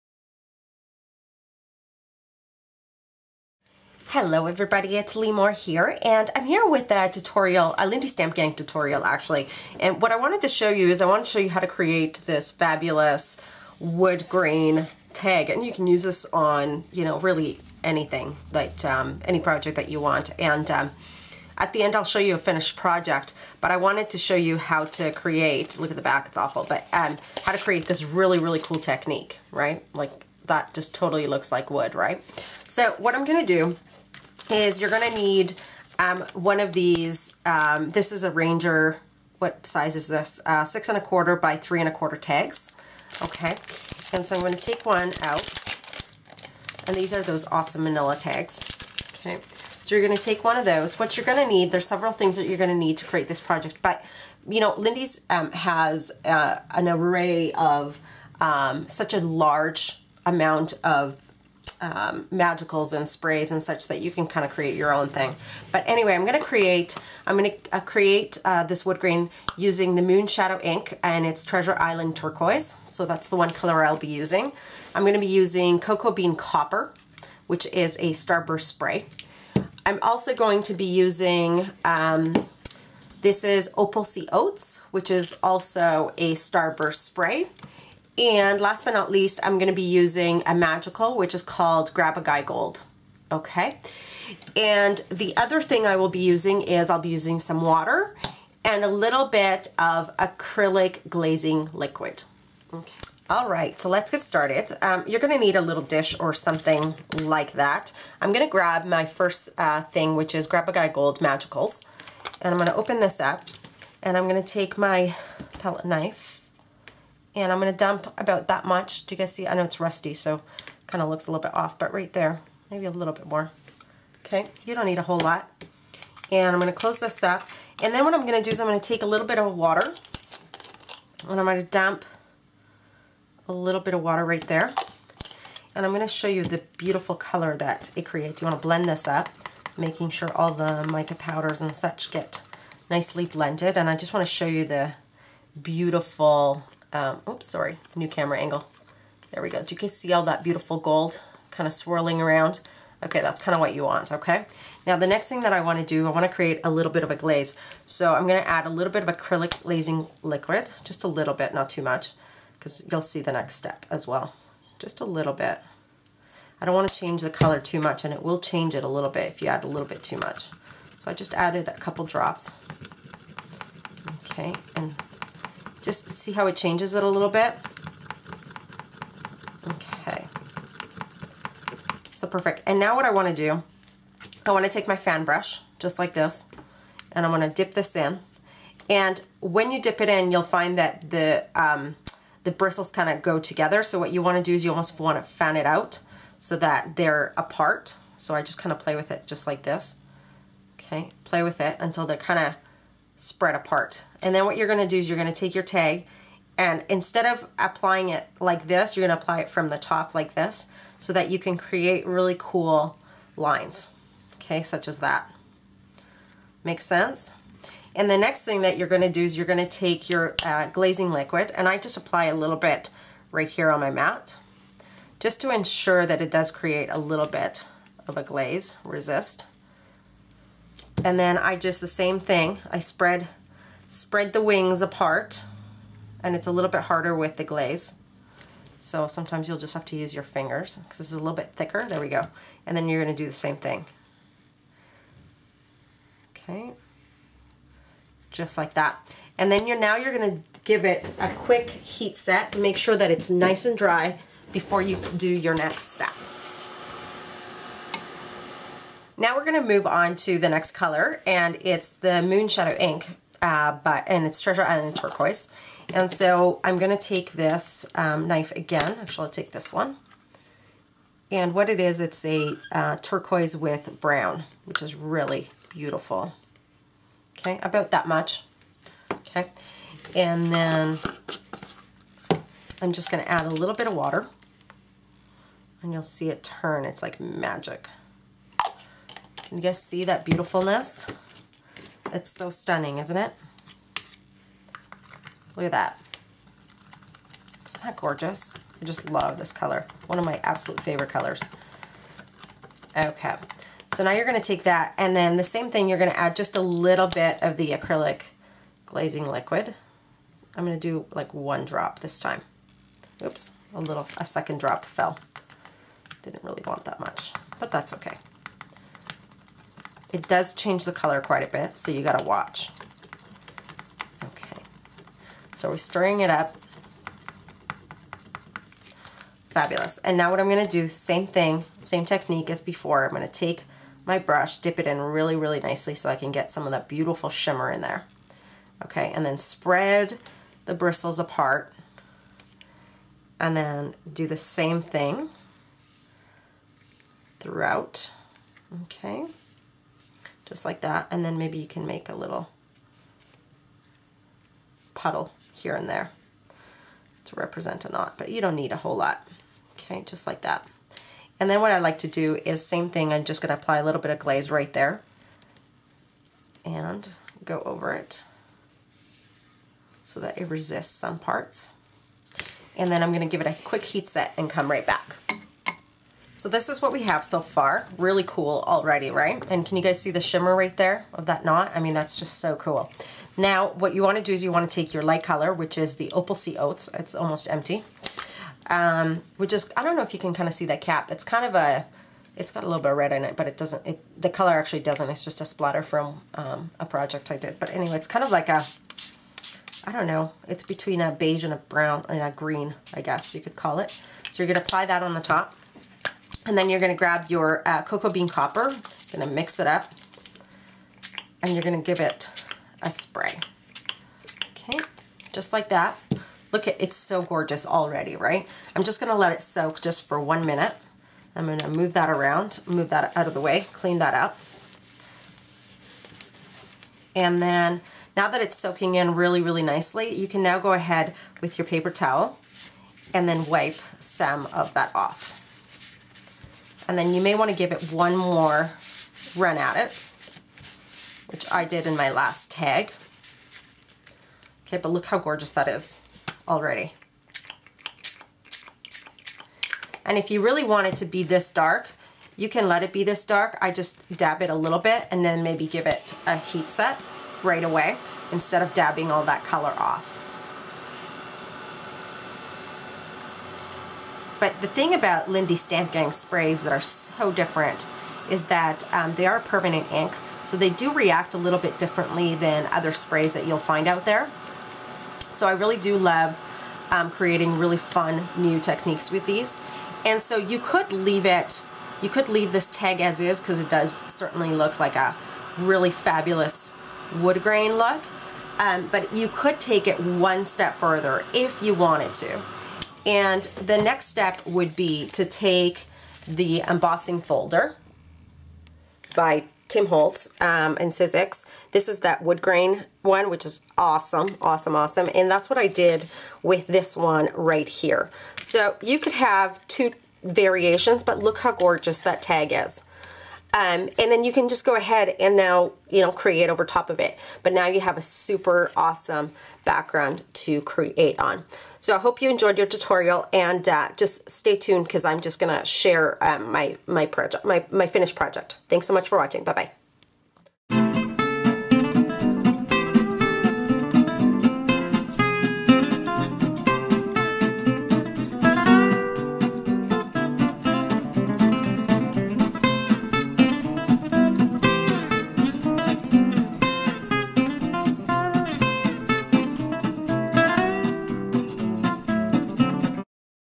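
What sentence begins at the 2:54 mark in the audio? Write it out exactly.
Okay, and just see how it changes it a little bit.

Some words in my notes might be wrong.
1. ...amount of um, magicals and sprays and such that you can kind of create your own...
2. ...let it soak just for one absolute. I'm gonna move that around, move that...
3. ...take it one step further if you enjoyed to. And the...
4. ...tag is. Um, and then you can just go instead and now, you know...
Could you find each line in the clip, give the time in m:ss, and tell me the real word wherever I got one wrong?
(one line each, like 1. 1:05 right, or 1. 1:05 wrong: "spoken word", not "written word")
1. 1:00 right
2. 6:59 wrong: "minute", not "absolute"
3. 8:09 wrong: "wanted", not "enjoyed"
4. 8:32 wrong: "ahead", not "instead".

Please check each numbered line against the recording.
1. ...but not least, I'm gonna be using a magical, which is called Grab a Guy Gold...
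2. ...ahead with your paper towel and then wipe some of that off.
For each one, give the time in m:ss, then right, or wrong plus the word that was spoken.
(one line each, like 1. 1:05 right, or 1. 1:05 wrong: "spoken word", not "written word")
1. 1:28 right
2. 7:10 right.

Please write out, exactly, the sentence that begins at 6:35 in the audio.
It's just a splatter from um, a project I did.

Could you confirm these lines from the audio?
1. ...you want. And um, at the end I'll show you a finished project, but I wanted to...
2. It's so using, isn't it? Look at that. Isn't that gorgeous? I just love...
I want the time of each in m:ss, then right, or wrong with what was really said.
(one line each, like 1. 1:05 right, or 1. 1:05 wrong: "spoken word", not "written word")
1. 0:19 right
2. 4:52 wrong: "stunning", not "using".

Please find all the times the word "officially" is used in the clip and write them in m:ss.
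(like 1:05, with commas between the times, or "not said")
not said.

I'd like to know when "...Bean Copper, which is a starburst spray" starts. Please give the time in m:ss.
1:16.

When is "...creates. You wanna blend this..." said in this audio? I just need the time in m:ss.
2:18.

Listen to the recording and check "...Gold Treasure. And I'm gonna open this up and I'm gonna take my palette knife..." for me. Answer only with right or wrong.
wrong.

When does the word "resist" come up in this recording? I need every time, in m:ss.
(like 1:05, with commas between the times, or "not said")
3:48, 6:10.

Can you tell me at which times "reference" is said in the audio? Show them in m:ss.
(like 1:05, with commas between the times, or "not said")
not said.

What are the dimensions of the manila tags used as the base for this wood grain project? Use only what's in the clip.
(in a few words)
6 1/4 by 3 1/4.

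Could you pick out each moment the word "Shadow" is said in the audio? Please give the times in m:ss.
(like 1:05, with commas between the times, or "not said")
1:10, 4:22.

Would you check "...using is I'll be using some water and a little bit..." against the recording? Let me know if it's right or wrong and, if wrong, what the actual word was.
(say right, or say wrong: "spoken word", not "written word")
right.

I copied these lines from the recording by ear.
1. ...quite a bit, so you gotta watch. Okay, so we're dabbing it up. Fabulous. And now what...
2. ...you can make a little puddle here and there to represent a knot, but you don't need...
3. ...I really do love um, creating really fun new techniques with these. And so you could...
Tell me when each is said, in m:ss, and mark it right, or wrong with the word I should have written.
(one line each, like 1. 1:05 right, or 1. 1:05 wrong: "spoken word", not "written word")
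1. 5:21 wrong: "stirring", not "dabbing"
2. 5:51 right
3. 7:55 right.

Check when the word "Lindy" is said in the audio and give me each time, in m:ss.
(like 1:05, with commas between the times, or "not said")
0:07, 0:54, 7:45.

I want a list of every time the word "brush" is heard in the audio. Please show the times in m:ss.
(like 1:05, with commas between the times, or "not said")
3:05, 5:34.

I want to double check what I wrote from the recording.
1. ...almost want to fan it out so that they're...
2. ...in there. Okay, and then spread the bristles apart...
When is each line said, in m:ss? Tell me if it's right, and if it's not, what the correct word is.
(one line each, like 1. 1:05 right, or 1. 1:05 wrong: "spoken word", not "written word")
1. 3:14 right
2. 5:37 right.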